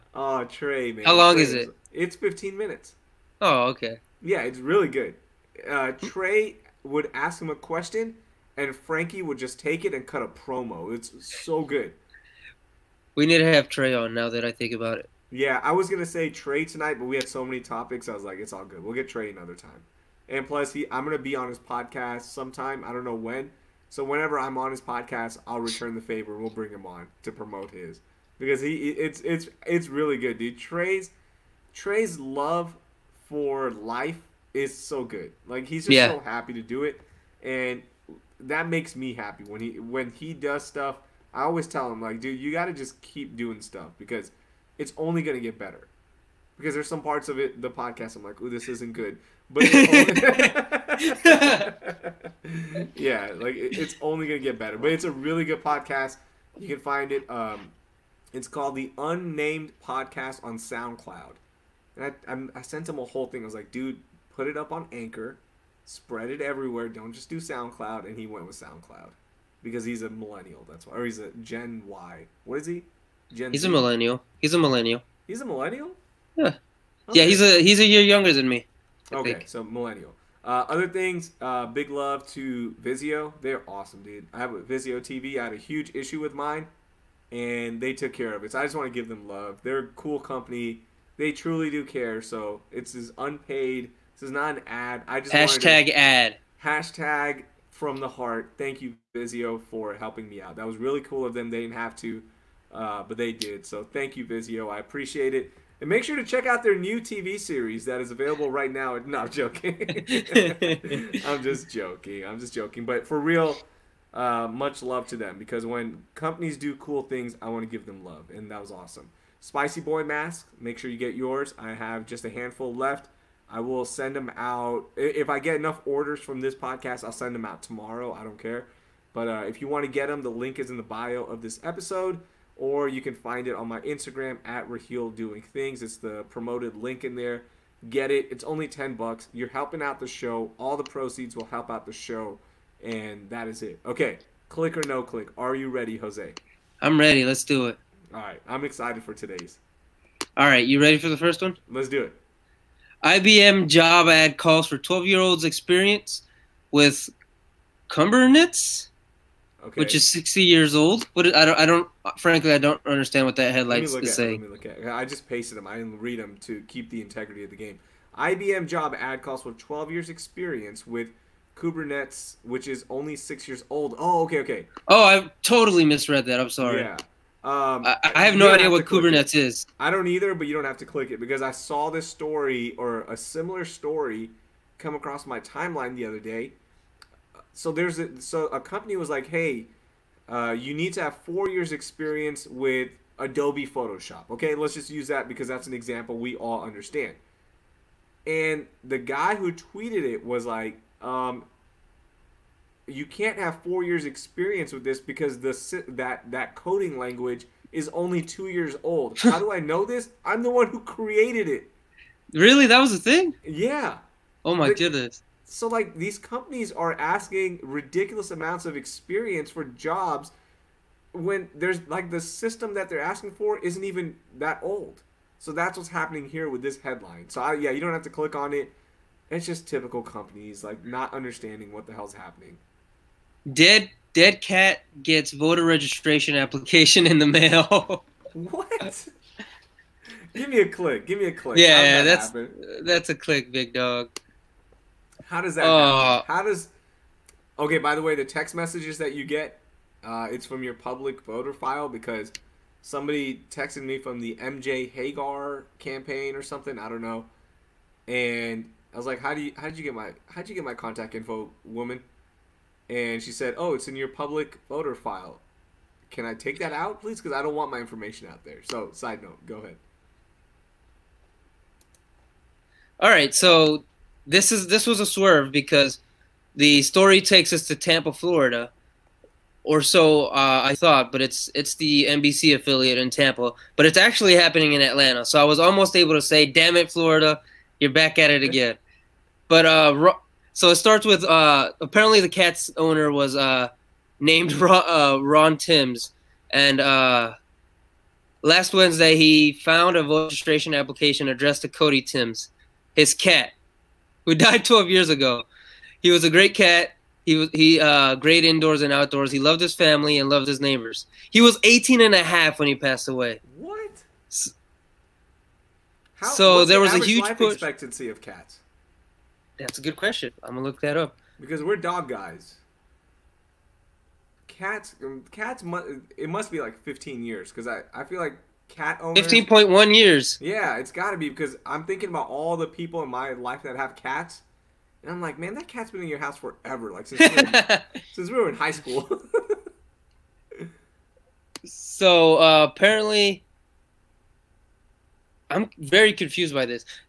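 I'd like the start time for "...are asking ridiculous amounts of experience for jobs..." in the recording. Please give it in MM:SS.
03:36.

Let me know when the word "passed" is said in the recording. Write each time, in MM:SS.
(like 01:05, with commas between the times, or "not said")
05:12.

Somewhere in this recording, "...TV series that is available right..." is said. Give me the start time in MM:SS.
01:47.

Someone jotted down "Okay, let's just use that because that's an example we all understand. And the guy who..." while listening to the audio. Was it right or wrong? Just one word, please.
right.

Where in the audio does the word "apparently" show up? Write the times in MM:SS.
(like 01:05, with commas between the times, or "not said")
04:51, 05:42.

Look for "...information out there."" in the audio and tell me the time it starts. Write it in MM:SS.
04:27.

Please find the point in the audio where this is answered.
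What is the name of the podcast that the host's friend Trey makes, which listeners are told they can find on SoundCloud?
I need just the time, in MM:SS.
00:58.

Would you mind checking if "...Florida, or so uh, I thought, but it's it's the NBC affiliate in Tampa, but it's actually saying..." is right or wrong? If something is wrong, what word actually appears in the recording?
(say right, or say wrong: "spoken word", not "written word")
wrong: "happening", not "saying".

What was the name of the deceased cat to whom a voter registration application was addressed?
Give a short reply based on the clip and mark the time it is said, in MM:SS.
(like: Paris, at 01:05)
Cody Timms, at 05:01.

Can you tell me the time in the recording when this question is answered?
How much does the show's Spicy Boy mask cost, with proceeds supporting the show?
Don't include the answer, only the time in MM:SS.
02:18.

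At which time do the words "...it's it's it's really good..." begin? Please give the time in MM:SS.
00:28.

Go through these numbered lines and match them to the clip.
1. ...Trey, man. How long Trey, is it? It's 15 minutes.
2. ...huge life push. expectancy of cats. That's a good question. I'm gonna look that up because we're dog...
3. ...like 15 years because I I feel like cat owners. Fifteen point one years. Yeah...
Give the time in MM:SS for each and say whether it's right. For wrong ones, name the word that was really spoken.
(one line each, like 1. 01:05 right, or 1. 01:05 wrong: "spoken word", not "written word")
1. 00:00 right
2. 05:17 right
3. 05:26 right.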